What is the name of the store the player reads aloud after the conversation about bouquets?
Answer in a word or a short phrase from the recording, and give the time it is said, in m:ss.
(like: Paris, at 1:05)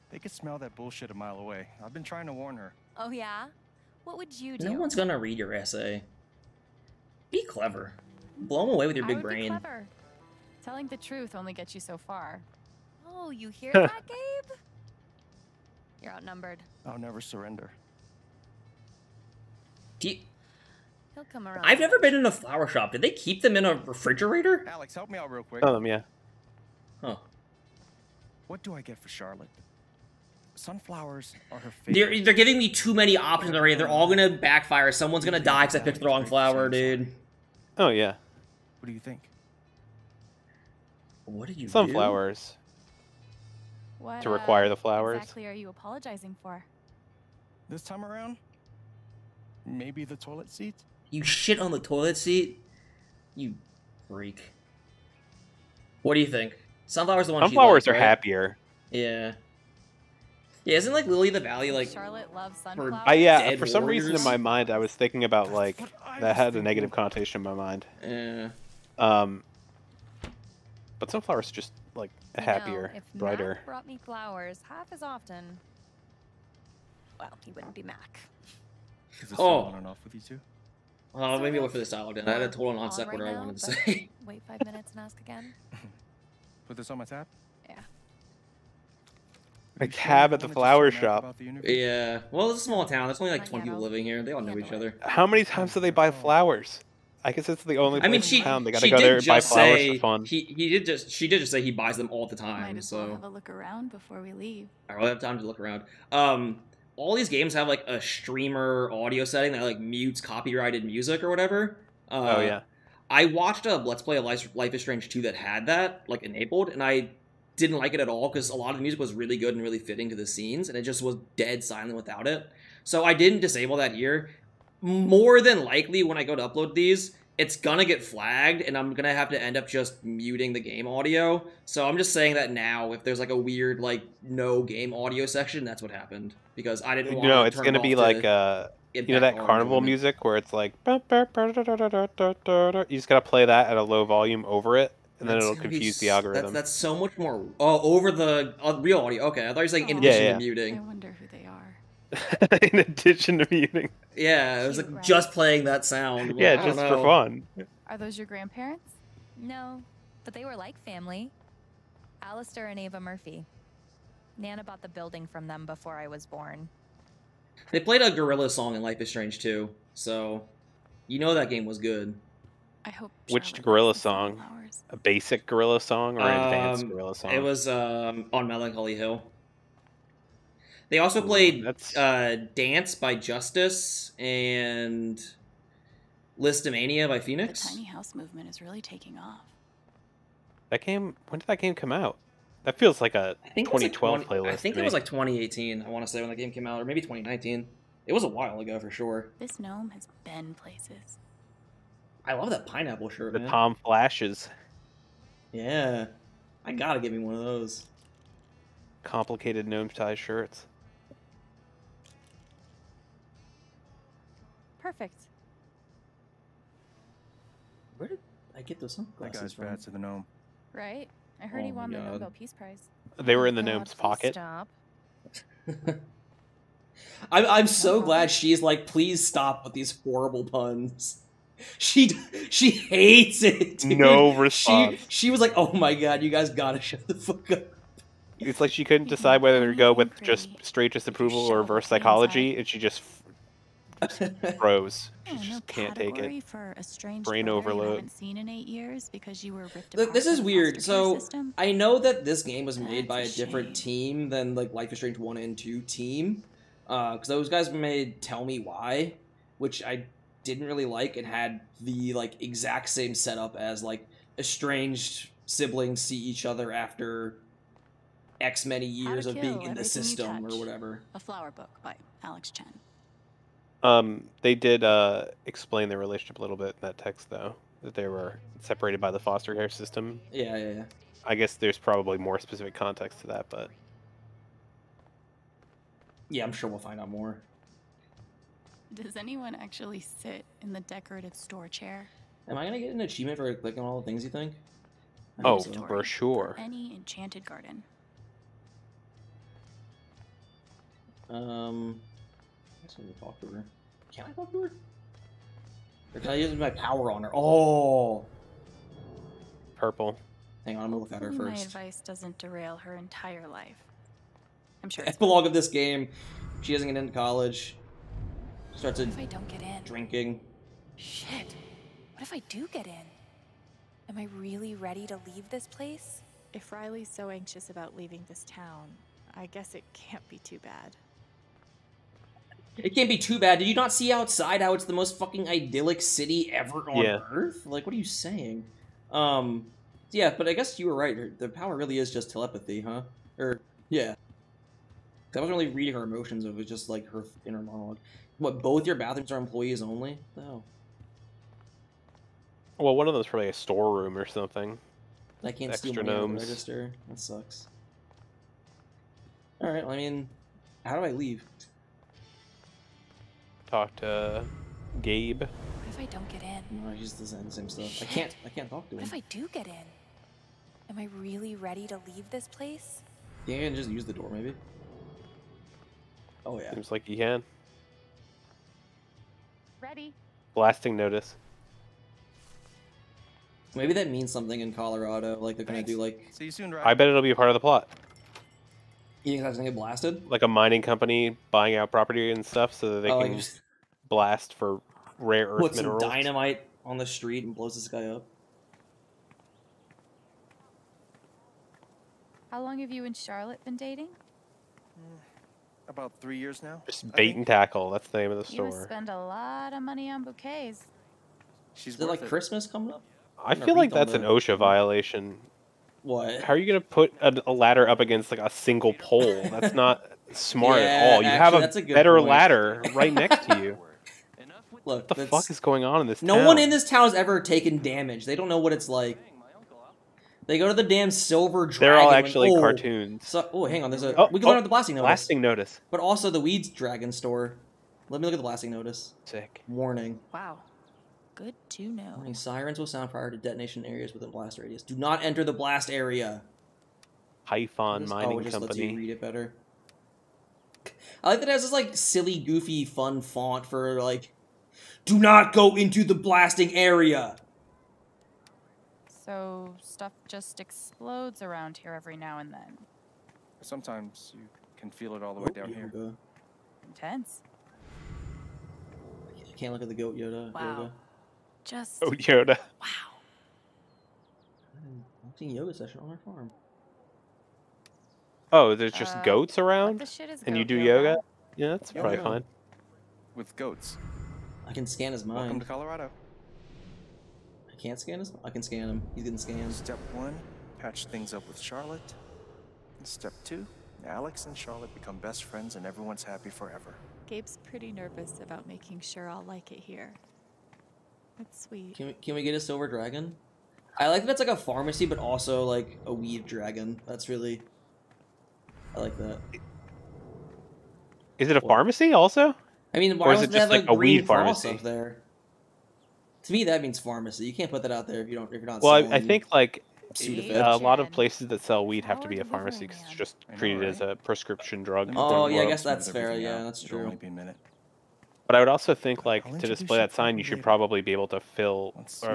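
Bait and Tackle, at 6:47.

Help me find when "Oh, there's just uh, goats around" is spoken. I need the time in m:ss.
7:58.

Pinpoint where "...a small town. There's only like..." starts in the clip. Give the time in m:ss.
1:32.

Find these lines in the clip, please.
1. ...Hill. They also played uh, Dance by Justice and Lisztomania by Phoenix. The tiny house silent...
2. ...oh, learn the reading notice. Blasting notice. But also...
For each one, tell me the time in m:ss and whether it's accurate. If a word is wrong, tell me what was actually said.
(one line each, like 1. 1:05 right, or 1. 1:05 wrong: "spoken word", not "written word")
1. 2:58 wrong: "movement", not "silent"
2. 7:14 wrong: "blasting", not "reading".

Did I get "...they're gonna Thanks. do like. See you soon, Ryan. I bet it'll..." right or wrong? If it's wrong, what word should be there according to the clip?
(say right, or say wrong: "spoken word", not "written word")
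right.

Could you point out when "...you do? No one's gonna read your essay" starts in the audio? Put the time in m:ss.
0:04.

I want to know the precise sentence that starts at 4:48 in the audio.
Does anyone actually sit in the decorative store chair?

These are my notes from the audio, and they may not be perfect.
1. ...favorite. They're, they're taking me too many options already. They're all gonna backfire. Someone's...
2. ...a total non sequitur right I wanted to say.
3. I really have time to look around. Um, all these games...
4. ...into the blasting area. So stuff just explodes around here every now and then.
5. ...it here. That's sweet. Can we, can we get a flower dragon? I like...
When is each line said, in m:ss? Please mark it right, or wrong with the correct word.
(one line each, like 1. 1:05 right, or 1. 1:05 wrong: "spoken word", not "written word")
1. 0:31 wrong: "giving", not "taking"
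2. 1:22 right
3. 1:44 right
4. 7:35 right
5. 8:19 wrong: "silver", not "flower".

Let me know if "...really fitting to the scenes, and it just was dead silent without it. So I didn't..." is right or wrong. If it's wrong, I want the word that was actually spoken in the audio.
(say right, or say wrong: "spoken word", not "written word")
right.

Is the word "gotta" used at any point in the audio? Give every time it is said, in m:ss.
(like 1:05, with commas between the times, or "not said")
1:38, 2:23, 3:26, 3:56.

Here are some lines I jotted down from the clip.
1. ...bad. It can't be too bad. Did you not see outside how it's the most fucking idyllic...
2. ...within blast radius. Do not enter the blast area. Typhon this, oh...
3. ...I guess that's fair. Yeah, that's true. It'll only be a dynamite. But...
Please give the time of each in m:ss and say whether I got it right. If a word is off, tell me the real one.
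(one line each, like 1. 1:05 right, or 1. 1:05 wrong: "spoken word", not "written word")
1. 5:30 right
2. 7:24 right
3. 8:45 wrong: "minute", not "dynamite".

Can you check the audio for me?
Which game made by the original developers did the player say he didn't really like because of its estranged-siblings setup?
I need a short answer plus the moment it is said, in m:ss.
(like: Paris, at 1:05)
Tell Me Why, at 4:18.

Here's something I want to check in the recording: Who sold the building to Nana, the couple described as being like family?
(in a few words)
Alistair and Ava Murphy.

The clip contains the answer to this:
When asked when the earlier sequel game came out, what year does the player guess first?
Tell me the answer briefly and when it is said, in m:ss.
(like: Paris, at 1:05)
2018, at 3:15.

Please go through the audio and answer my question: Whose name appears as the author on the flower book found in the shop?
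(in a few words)
Alex Chen.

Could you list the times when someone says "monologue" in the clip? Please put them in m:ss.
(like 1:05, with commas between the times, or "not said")
5:47.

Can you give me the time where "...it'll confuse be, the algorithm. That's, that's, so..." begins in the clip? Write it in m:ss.
2:25.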